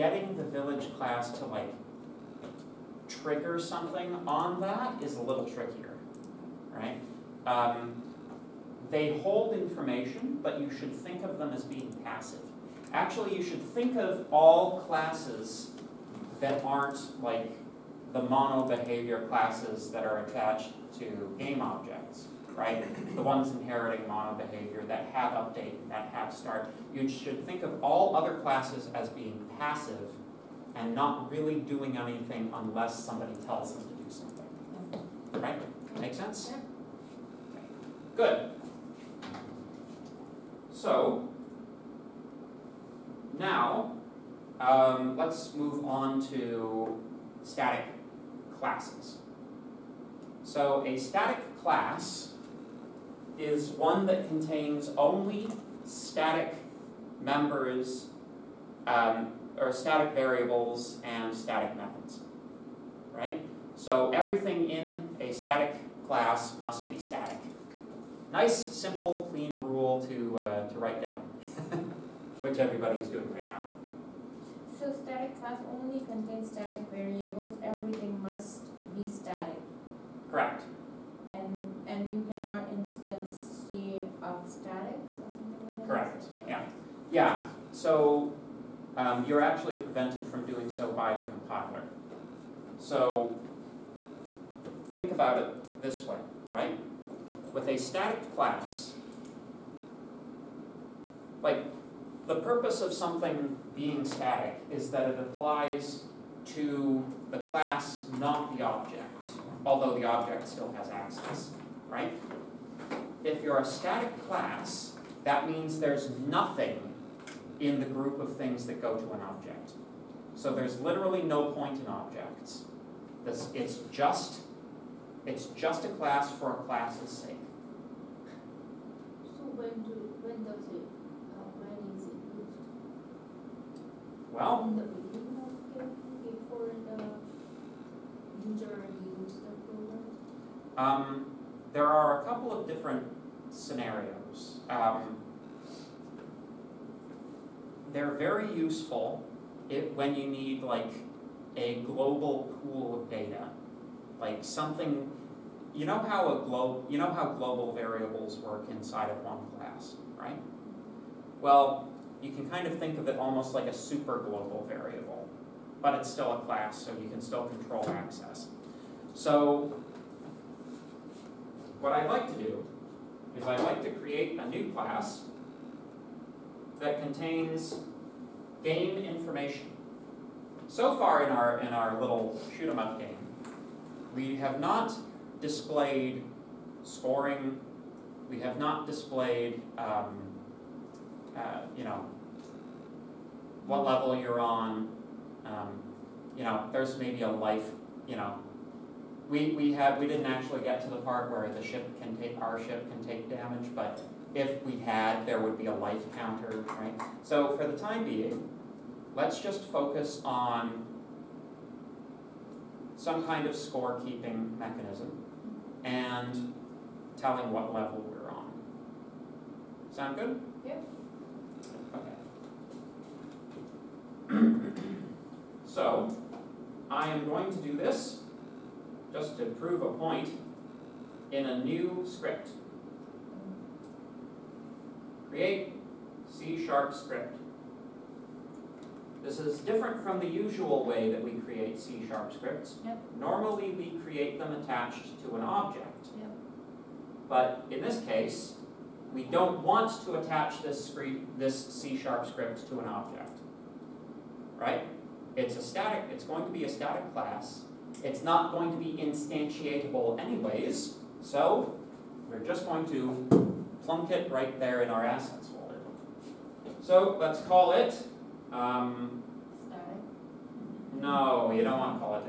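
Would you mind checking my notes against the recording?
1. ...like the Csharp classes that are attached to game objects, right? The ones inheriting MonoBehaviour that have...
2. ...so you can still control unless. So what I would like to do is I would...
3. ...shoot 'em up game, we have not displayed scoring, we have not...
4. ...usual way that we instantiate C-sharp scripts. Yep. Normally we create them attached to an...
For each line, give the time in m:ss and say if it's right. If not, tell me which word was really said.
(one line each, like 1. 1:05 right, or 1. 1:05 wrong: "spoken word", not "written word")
1. 0:17 wrong: "MonoBehaviour", not "Csharp"
2. 2:46 wrong: "access", not "unless"
3. 3:02 right
4. 4:00 wrong: "create", not "instantiate".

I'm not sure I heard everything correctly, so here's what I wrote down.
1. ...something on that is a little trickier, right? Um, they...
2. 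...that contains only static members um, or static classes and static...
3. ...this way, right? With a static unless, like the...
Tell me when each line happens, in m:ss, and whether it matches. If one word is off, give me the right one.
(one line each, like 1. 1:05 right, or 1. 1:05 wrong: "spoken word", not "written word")
1. 0:03 right
2. 0:54 wrong: "variables", not "classes"
3. 1:35 wrong: "class", not "unless".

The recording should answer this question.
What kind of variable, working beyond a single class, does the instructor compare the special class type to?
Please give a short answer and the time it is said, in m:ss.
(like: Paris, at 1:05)
super global variable, at 2:43.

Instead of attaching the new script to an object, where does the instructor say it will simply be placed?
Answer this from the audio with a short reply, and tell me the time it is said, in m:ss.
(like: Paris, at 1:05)
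assets folder, at 4:25.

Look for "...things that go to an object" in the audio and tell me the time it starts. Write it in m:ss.
1:58.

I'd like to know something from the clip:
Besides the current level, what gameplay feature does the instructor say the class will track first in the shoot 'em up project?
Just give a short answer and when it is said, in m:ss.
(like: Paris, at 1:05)
scorekeeping, at 3:33.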